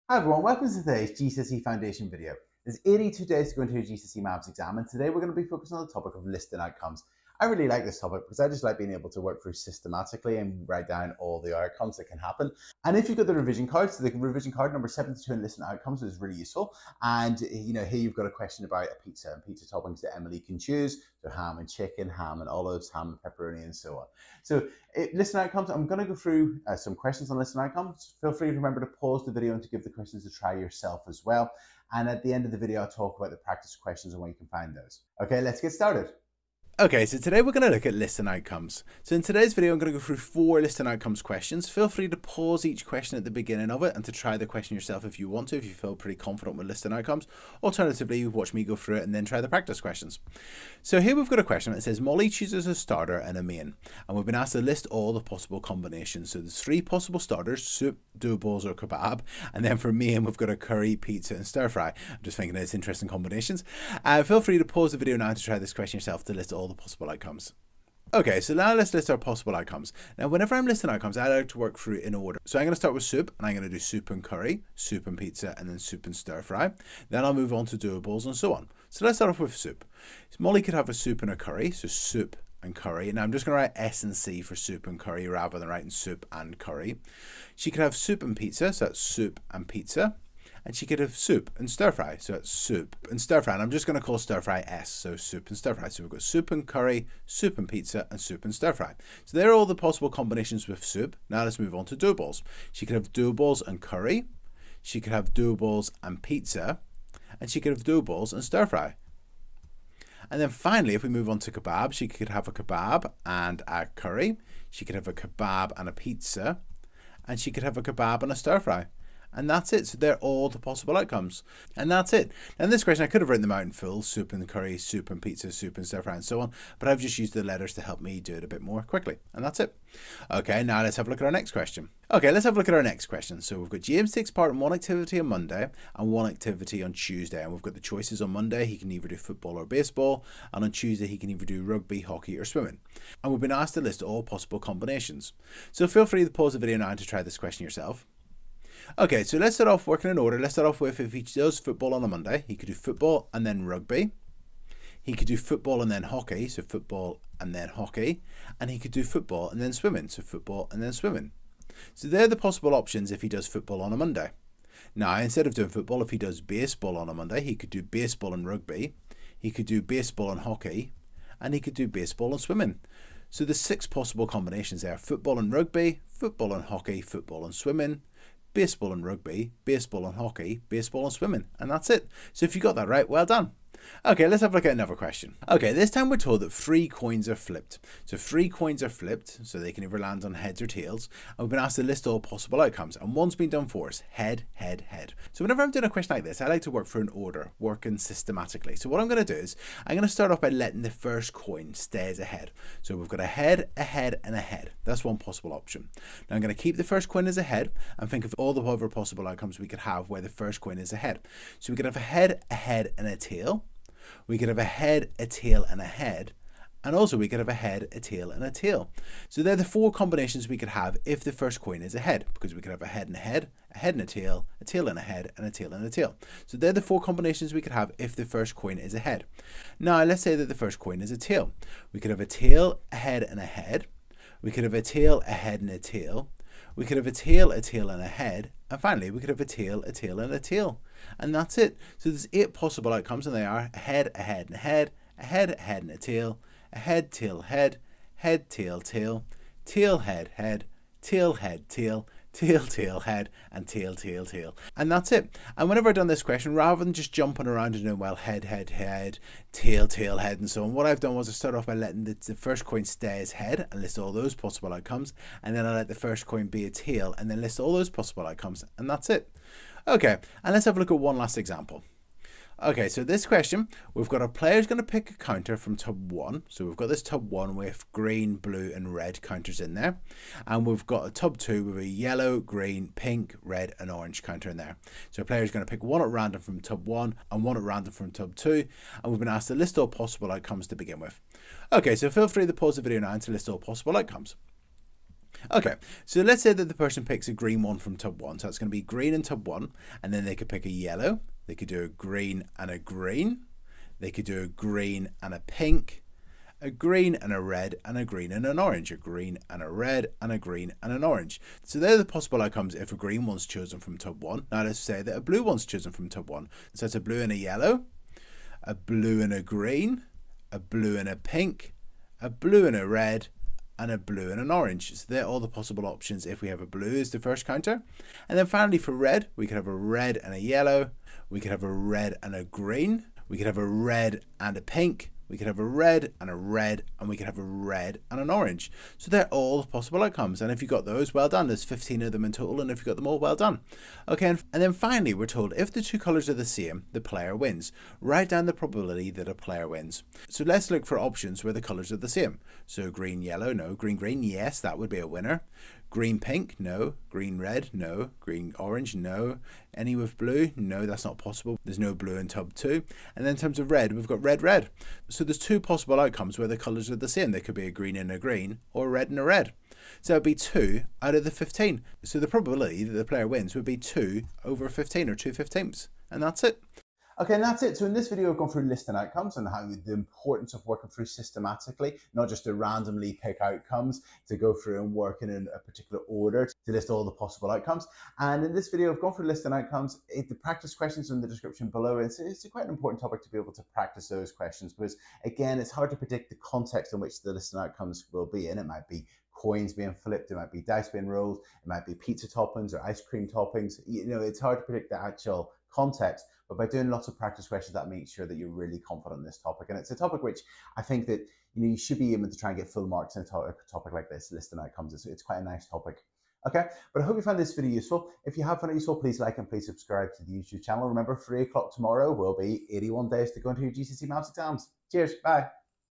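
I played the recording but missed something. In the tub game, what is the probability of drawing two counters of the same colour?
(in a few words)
2/15.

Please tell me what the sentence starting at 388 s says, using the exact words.
And in this video, I've gone through listing outcomes.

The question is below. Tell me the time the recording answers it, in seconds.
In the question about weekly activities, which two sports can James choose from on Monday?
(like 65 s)
139 s.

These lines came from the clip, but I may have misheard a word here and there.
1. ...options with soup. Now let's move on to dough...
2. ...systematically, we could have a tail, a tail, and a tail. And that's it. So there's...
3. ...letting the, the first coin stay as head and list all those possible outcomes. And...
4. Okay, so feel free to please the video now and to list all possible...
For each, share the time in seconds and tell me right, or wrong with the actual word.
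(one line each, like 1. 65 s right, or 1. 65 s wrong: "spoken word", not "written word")
1. 100 s wrong: "combinations", not "options"
2. 238 s wrong: "finally", not "systematically"
3. 261 s right
4. 291 s wrong: "pause", not "please".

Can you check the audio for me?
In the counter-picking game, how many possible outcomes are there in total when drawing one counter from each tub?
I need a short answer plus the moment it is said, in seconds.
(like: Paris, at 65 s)
15, at 341 s.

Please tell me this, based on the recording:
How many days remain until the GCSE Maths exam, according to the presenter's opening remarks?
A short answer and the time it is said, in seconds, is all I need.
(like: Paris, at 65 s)
82, at 2 s.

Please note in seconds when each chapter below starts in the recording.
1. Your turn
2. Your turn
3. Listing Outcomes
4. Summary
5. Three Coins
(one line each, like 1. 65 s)
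1. 131 s
2. 272 s
3. 36 s
4. 376 s
5. 184 s.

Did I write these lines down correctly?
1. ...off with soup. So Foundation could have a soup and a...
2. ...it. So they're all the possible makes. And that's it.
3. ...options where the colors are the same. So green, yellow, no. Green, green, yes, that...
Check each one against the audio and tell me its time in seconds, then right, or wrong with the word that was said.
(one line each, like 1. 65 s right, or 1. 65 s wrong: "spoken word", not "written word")
1. 79 s wrong: "Molly", not "Foundation"
2. 119 s wrong: "outcomes", not "makes"
3. 350 s right.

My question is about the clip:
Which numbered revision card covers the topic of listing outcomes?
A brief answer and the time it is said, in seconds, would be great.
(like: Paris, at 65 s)
72, at 14 s.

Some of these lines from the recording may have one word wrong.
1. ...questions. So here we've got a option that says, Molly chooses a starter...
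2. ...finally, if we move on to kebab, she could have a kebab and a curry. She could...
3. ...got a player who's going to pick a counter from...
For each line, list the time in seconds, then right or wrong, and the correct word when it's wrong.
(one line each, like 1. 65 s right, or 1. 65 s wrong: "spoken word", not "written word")
1. 49 s wrong: "question", not "option"
2. 110 s right
3. 274 s right.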